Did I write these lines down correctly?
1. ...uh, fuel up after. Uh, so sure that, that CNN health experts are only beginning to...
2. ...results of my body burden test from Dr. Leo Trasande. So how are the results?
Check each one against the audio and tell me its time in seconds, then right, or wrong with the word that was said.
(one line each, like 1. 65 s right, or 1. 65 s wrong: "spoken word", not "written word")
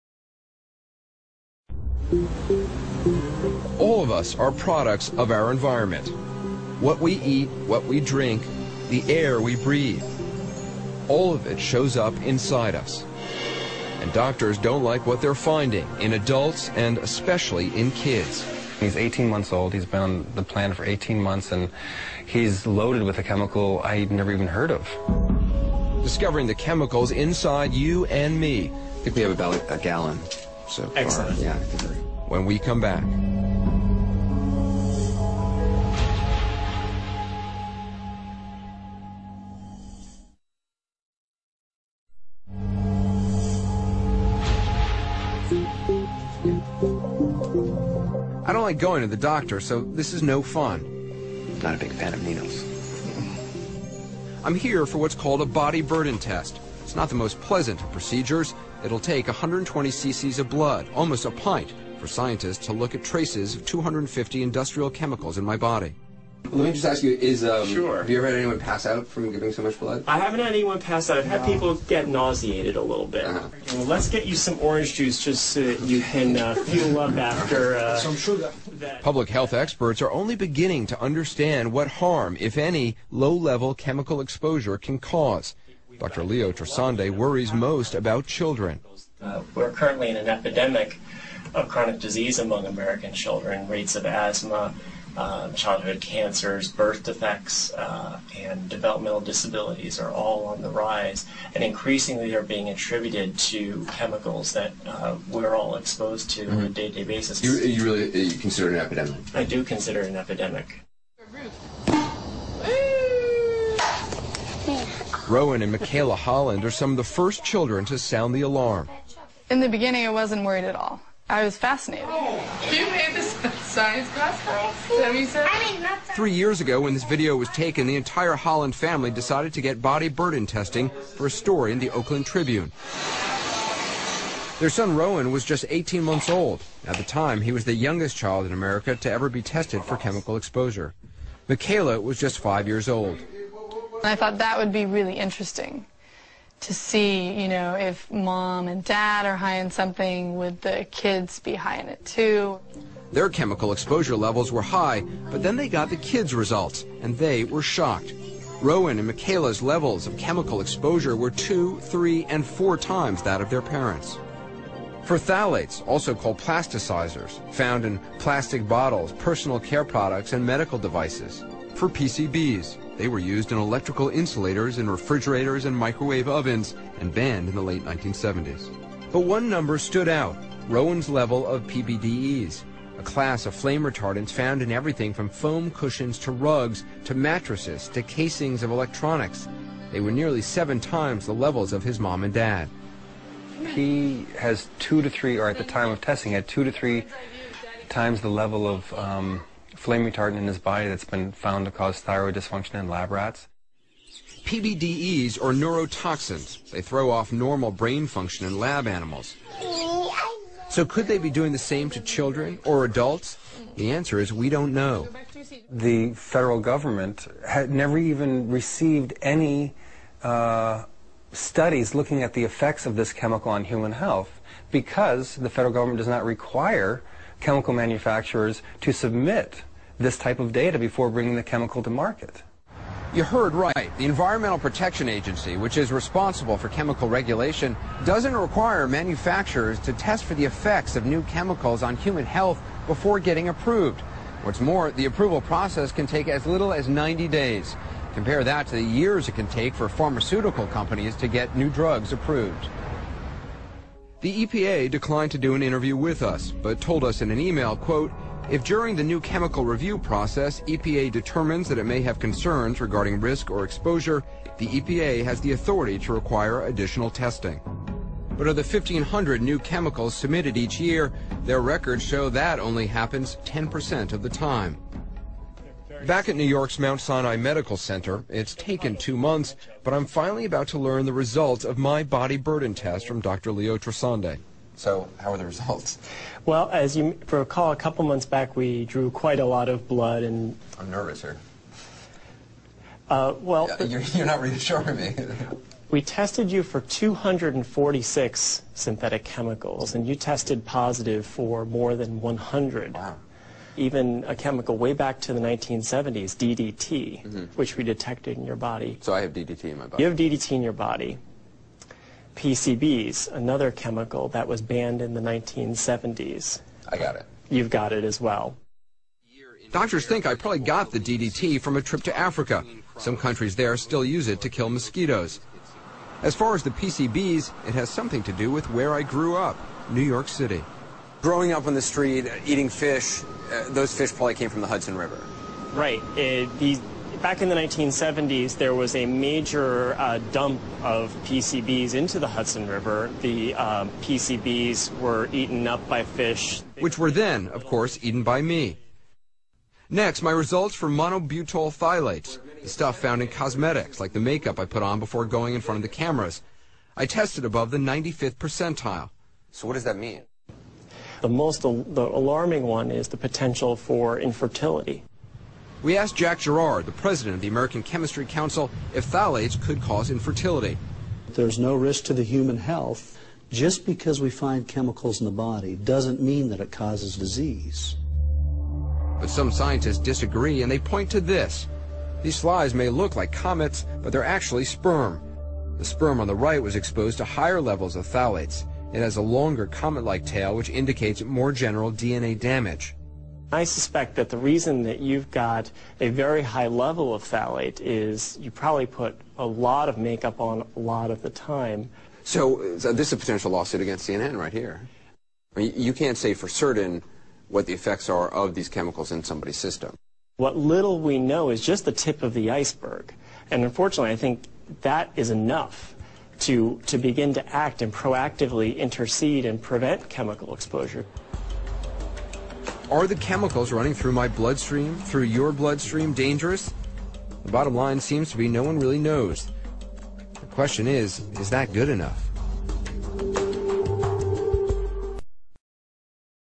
1. 76 s wrong: "Public", not "CNN"
2. 281 s right.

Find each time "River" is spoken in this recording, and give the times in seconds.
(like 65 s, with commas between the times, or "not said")
334 s, 342 s.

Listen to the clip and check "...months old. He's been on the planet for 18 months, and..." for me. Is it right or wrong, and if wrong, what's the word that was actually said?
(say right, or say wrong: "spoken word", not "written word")
right.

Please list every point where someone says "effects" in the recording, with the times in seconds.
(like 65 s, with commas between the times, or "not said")
222 s, 240 s, 407 s.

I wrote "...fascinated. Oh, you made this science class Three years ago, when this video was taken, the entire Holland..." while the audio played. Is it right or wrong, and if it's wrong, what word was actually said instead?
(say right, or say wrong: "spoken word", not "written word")
right.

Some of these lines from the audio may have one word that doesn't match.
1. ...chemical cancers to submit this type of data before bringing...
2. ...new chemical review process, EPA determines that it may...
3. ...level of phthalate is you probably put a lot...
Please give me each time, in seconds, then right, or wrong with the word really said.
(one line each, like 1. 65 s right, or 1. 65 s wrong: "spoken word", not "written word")
1. 227 s wrong: "manufacturers", not "cancers"
2. 259 s right
3. 396 s right.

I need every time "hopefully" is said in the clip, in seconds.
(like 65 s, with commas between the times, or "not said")
not said.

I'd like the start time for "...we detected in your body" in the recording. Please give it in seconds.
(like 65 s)
307 s.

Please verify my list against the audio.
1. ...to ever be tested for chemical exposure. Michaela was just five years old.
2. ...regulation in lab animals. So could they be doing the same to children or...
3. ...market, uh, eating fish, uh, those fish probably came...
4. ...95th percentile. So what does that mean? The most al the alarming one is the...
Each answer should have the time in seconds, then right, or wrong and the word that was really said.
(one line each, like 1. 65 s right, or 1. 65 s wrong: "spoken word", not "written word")
1. 138 s right
2. 208 s wrong: "function", not "regulation"
3. 331 s wrong: "street", not "market"
4. 357 s right.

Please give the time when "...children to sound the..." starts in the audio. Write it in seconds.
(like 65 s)
117 s.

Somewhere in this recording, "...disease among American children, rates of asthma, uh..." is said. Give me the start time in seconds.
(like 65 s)
91 s.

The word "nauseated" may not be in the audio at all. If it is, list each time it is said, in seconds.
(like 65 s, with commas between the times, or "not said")
72 s.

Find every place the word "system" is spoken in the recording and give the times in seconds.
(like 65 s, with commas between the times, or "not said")
409 s.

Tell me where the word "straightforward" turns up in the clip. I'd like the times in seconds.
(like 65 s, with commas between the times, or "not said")
not said.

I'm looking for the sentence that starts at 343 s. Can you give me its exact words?
The uh, um, PCBs were eaten up by fish.